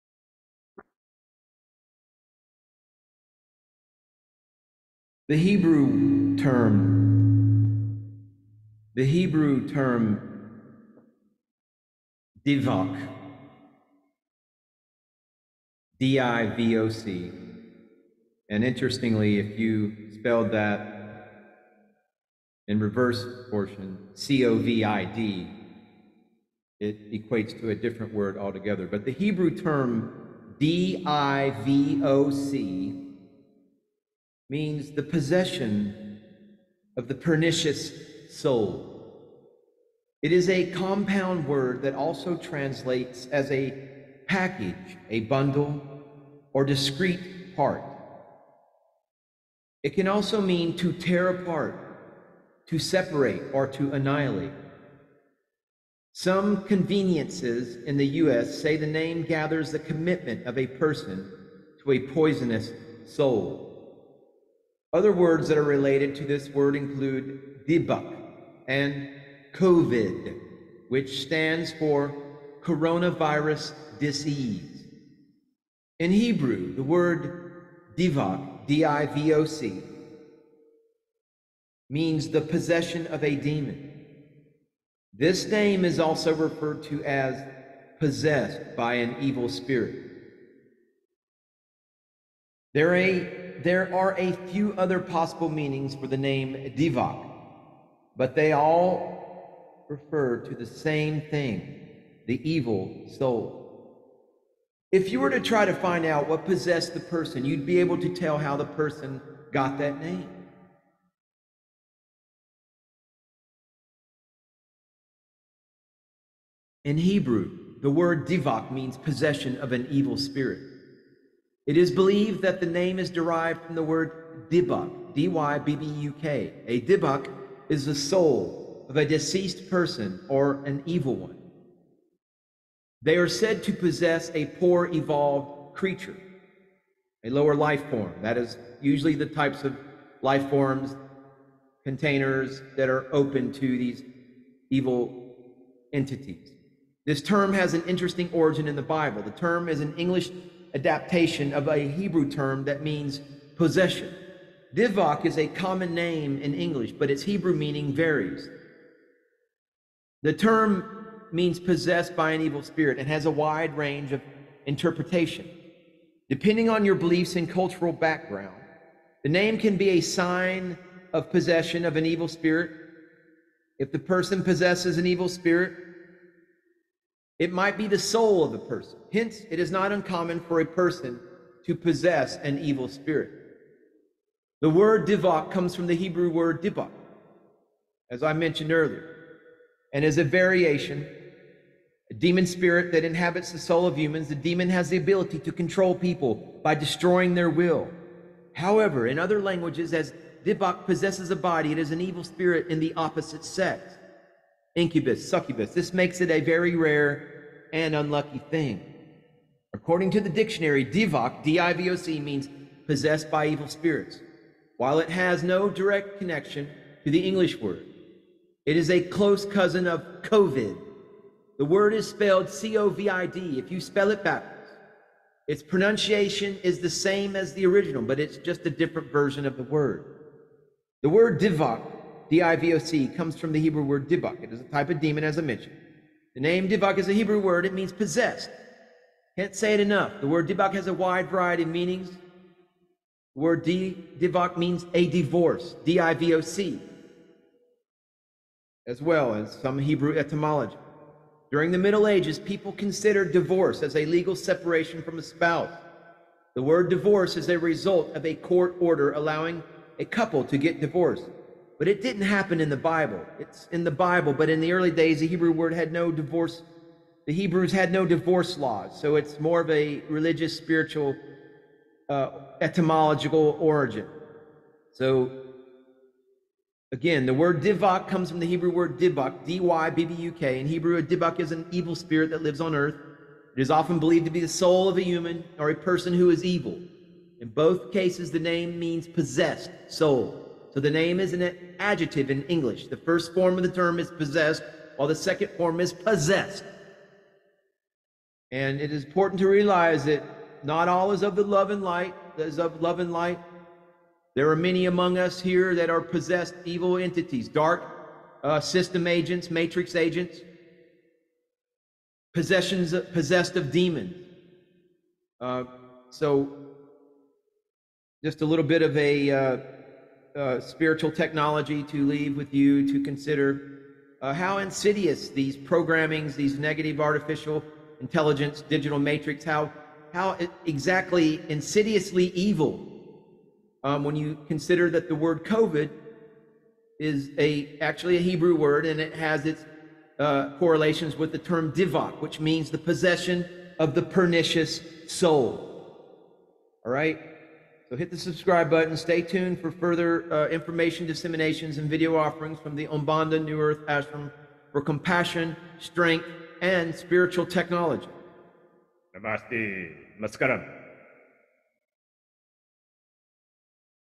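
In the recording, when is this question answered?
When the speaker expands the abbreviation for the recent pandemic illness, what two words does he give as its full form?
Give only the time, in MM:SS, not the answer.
01:12.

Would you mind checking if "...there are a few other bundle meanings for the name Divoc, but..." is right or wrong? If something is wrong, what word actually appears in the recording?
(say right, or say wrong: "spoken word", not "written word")
wrong: "possible", not "bundle".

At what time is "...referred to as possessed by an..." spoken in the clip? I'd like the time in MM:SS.
01:26.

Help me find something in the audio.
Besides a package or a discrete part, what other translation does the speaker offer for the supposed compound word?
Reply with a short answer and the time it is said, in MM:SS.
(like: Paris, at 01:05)
a bundle, at 00:45.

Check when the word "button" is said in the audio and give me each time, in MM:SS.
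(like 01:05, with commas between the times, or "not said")
05:48.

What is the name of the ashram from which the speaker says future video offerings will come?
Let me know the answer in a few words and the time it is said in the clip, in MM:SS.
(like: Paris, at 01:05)
Aumbonda New Earth Ashram, at 05:52.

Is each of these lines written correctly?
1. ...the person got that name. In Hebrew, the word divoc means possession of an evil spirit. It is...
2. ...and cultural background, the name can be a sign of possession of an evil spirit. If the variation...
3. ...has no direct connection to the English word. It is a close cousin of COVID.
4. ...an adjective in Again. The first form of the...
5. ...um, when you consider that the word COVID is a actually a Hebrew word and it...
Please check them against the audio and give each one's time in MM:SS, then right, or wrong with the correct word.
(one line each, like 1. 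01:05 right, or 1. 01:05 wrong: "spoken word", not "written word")
1. 01:48 right
2. 02:47 wrong: "person", not "variation"
3. 03:35 right
4. 04:51 wrong: "English", not "Again"
5. 05:33 right.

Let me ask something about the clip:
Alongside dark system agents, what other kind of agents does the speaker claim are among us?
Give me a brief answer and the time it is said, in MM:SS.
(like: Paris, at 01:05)
matrix agents, at 05:09.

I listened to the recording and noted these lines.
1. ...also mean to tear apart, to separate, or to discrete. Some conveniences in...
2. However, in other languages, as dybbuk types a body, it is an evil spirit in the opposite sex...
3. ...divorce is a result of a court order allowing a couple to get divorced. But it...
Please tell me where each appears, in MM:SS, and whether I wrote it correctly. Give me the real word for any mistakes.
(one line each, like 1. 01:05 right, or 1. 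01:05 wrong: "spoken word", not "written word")
1. 00:50 wrong: "annihilate", not "discrete"
2. 03:18 wrong: "possesses", not "types"
3. 04:16 right.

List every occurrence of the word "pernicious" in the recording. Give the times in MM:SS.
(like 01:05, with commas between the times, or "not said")
00:37, 05:44.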